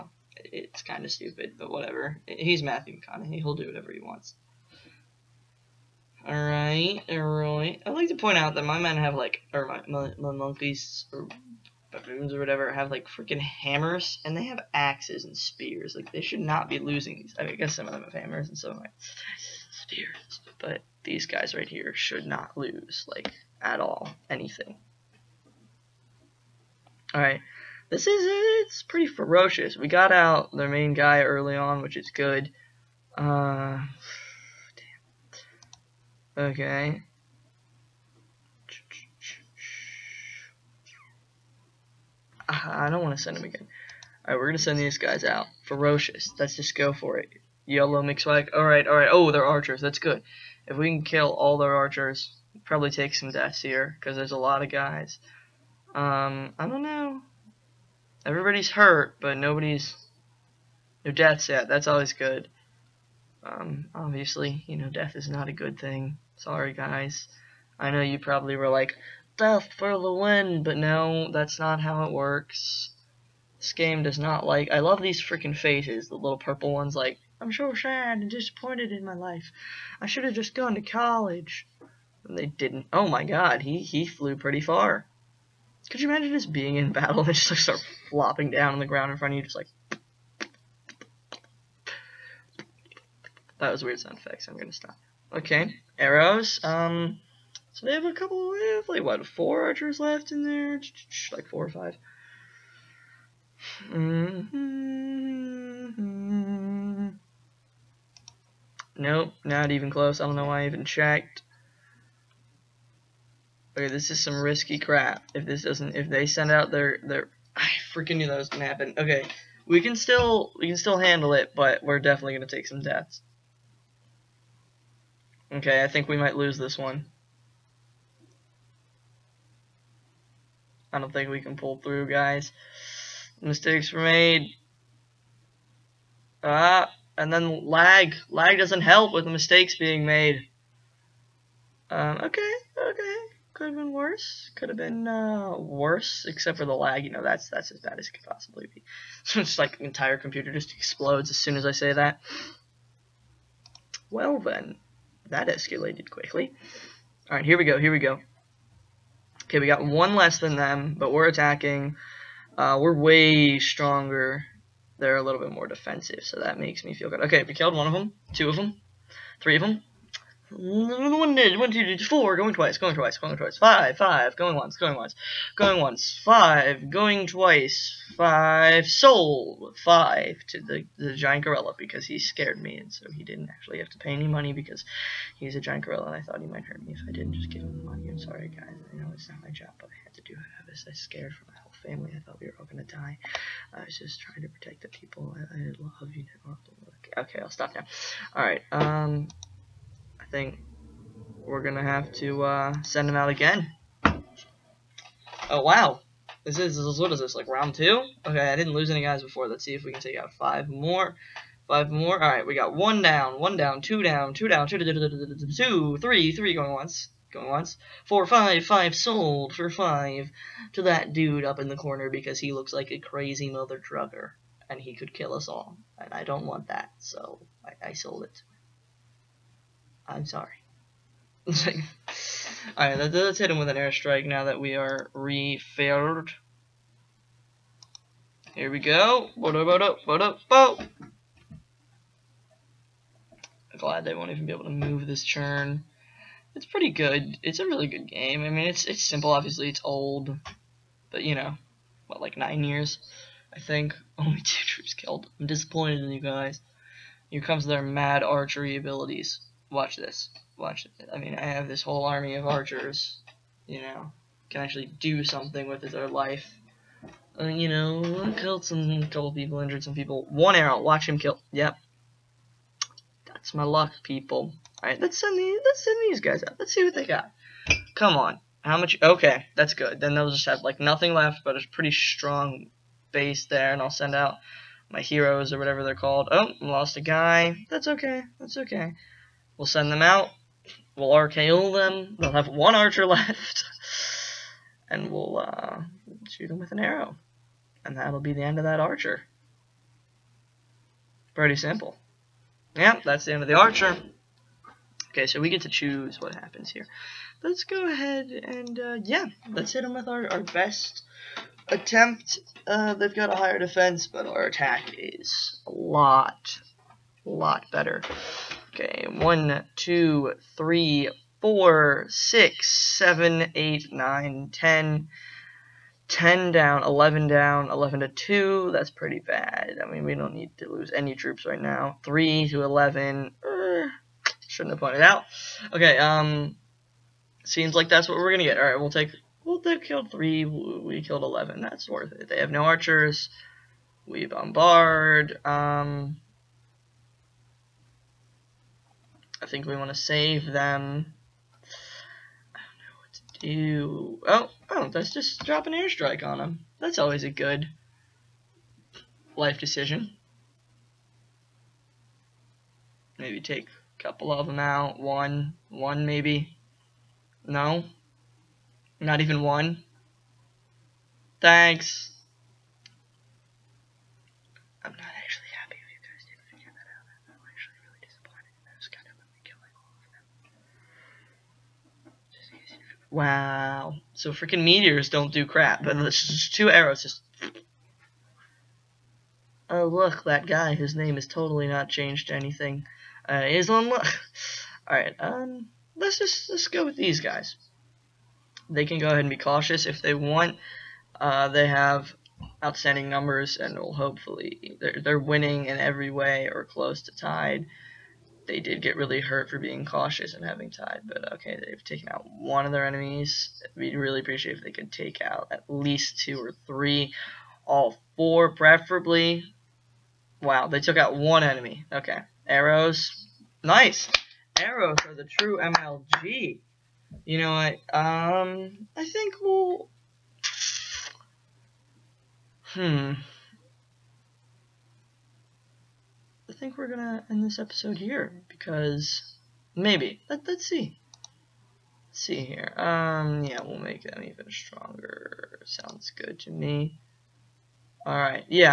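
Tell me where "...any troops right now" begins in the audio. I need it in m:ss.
5:30.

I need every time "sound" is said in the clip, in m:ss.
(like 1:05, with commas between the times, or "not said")
1:33, 7:25.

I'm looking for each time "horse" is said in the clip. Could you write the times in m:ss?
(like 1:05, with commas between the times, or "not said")
not said.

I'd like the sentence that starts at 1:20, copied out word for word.
I should have just gone to college.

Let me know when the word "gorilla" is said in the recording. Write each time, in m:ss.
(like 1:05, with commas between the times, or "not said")
3:01, 3:05.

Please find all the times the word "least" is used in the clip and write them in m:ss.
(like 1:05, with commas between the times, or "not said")
6:55.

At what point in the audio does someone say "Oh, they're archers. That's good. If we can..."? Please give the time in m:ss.
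0:49.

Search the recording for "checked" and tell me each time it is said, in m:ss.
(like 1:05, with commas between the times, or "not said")
1:50.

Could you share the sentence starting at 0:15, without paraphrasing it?
Like they should not be losing these.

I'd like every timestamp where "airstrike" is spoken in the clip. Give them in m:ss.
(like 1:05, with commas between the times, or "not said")
3:53, 5:55.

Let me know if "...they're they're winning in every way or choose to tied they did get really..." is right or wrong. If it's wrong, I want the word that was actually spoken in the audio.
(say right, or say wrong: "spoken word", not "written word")
wrong: "close", not "choose".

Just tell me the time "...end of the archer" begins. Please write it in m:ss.
5:03.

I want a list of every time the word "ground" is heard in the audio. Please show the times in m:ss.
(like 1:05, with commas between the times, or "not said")
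1:28.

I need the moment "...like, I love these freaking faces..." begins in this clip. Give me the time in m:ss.
1:14.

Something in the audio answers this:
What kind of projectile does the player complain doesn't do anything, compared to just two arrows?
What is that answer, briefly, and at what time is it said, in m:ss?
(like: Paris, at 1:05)
meteors, at 6:24.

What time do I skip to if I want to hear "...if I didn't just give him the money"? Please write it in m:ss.
3:06.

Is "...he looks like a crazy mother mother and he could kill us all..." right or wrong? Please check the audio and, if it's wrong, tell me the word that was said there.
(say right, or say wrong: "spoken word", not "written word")
wrong: "drugger", not "mother".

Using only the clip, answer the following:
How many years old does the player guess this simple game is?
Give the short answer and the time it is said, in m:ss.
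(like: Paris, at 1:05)
9, at 4:12.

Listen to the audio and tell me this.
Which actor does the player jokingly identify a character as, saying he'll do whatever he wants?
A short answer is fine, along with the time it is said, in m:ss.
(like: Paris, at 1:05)
Matthew McConaughey, at 0:02.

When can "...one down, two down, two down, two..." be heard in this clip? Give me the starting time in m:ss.
3:33.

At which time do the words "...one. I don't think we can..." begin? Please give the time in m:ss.
2:06.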